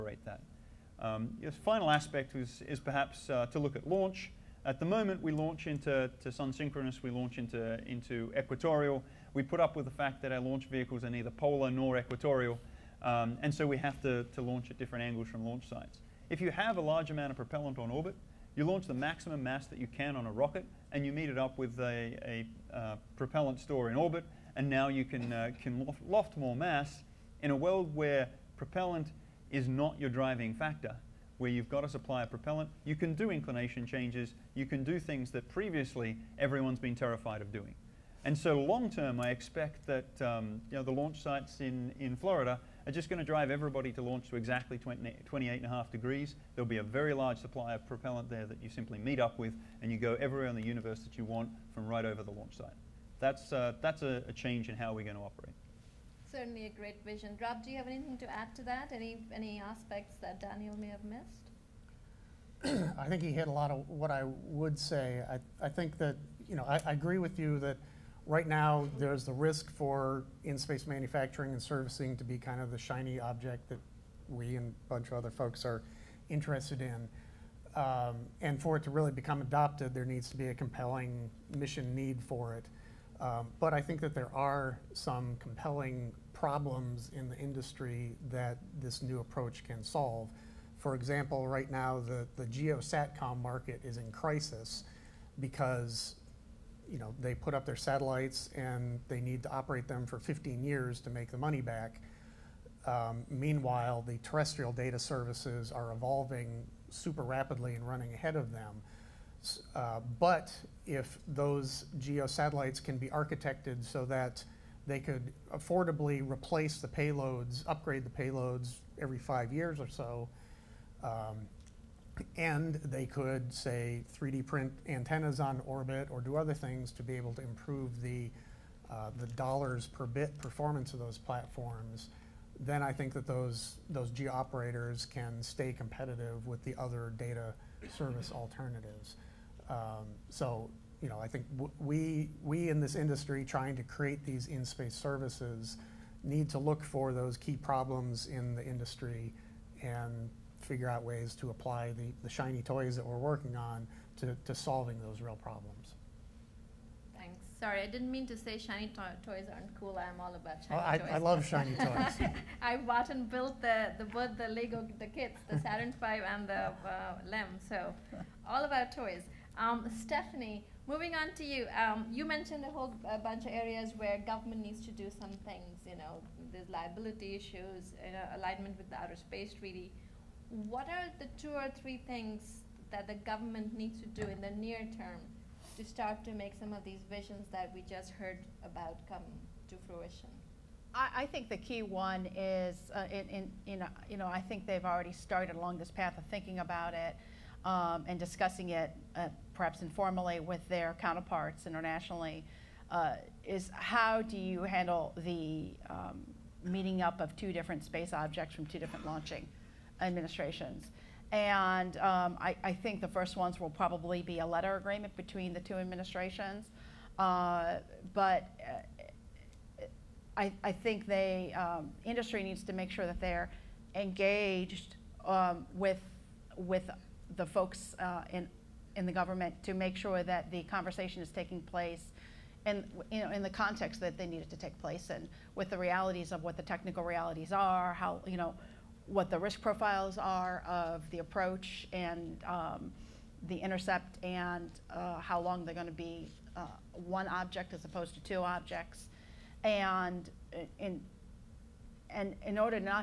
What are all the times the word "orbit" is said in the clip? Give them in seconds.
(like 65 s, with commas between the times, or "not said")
17 s, 23 s, 125 s.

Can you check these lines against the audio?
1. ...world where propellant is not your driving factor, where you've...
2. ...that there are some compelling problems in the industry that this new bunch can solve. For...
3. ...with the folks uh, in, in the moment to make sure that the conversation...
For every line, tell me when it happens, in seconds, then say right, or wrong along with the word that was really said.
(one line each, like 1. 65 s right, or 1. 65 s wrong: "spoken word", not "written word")
1. 27 s right
2. 84 s wrong: "approach", not "bunch"
3. 226 s wrong: "government", not "moment".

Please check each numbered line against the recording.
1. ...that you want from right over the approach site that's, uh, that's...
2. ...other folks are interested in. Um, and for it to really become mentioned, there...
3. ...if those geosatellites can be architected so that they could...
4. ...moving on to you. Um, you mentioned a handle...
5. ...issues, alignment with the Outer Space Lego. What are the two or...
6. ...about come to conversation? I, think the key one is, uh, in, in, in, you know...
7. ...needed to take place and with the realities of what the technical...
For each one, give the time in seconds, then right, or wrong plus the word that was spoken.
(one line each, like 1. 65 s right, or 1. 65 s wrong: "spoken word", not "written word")
1. 50 s wrong: "launch", not "approach"
2. 75 s wrong: "adopted", not "mentioned"
3. 110 s right
4. 170 s wrong: "whole", not "handle"
5. 177 s wrong: "Treaty", not "Lego"
6. 188 s wrong: "fruition", not "conversation"
7. 234 s right.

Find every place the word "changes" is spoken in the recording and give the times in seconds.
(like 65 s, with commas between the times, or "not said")
33 s, 54 s.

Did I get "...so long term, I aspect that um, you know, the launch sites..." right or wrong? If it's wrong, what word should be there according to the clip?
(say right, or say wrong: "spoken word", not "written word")
wrong: "expect", not "aspect".